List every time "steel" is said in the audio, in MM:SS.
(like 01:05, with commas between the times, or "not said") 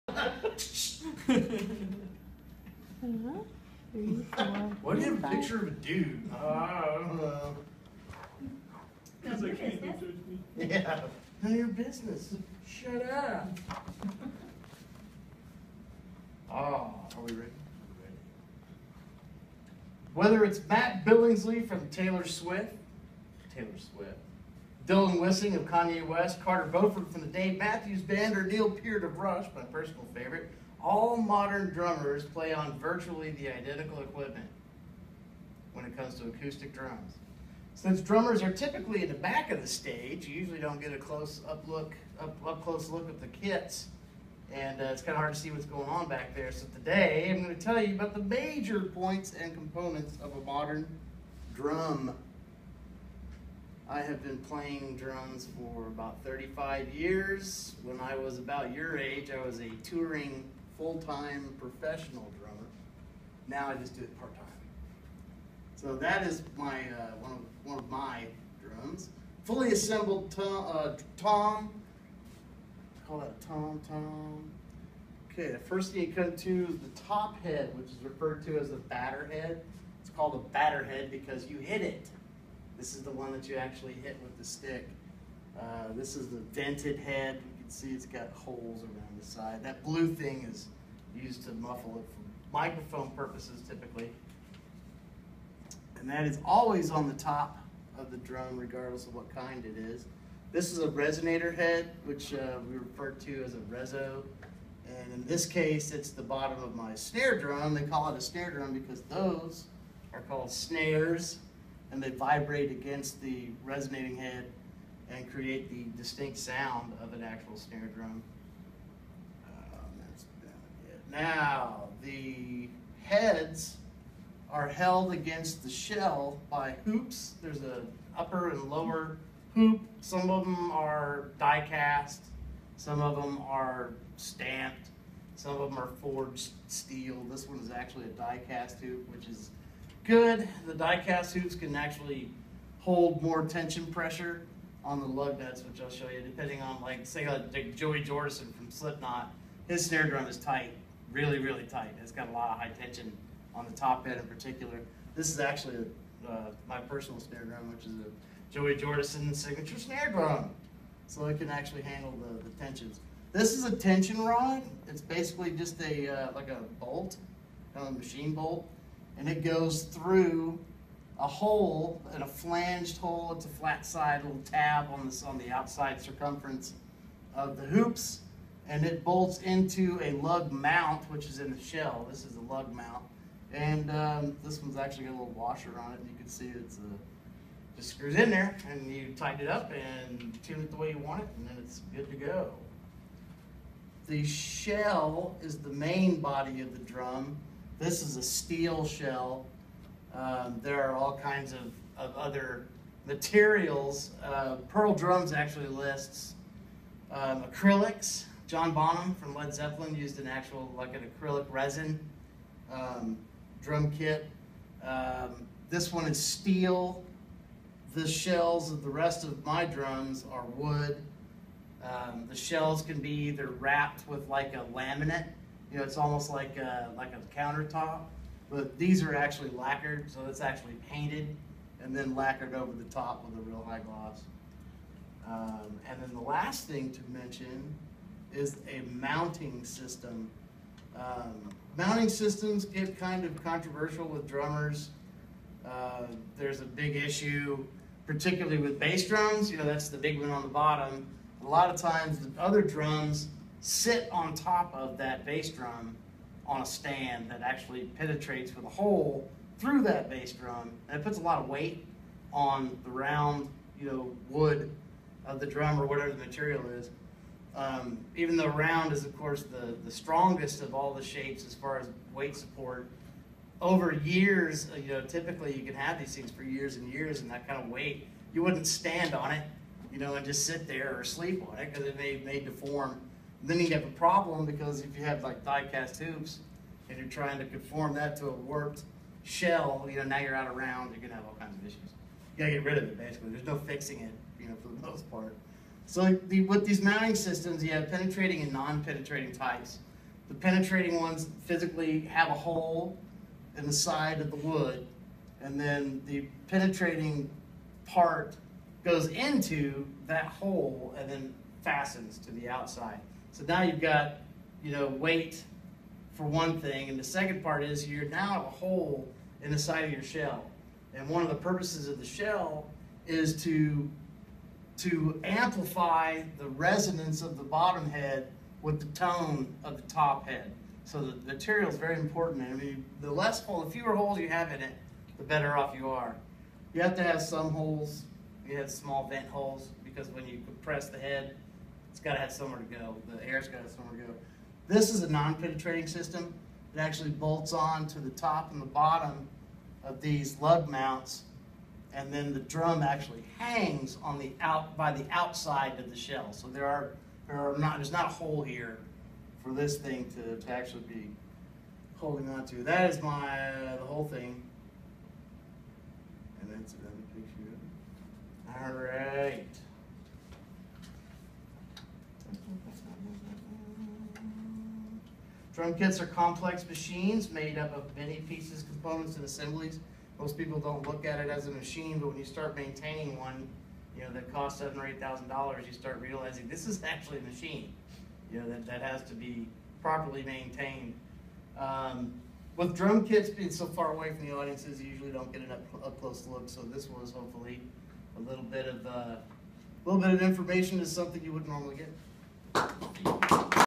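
02:16, 03:18, 03:36.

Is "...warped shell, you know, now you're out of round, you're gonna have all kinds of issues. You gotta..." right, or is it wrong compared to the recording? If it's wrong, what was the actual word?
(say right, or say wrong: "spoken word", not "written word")
right.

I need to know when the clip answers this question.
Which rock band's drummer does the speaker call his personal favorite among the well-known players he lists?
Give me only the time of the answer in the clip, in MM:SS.
00:29.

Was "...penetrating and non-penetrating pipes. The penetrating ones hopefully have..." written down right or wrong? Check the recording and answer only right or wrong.
wrong.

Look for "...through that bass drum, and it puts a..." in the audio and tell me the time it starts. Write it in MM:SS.
04:19.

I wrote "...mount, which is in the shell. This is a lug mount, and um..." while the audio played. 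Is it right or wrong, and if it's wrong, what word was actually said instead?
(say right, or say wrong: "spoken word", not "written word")
right.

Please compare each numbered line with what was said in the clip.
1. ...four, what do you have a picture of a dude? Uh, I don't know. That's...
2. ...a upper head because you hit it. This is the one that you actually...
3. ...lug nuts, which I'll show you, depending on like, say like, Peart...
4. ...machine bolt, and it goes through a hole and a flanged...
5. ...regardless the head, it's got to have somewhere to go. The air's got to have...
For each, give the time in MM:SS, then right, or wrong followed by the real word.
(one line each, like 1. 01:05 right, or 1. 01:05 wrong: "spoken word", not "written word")
1. 00:03 right
2. 01:20 wrong: "batter", not "upper"
3. 02:25 wrong: "Joey", not "Peart"
4. 02:47 right
5. 05:40 wrong: "compress", not "regardless".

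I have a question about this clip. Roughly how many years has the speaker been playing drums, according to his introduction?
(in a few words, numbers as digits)
35.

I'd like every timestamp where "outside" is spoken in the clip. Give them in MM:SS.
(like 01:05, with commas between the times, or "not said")
02:55, 05:12, 05:55.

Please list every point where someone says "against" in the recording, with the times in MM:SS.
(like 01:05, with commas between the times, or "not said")
01:52, 02:05.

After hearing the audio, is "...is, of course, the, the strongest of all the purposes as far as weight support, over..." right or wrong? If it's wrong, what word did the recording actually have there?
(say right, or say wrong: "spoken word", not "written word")
wrong: "shapes", not "purposes".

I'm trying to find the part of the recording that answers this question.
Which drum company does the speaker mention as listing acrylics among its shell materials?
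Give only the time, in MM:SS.
03:24.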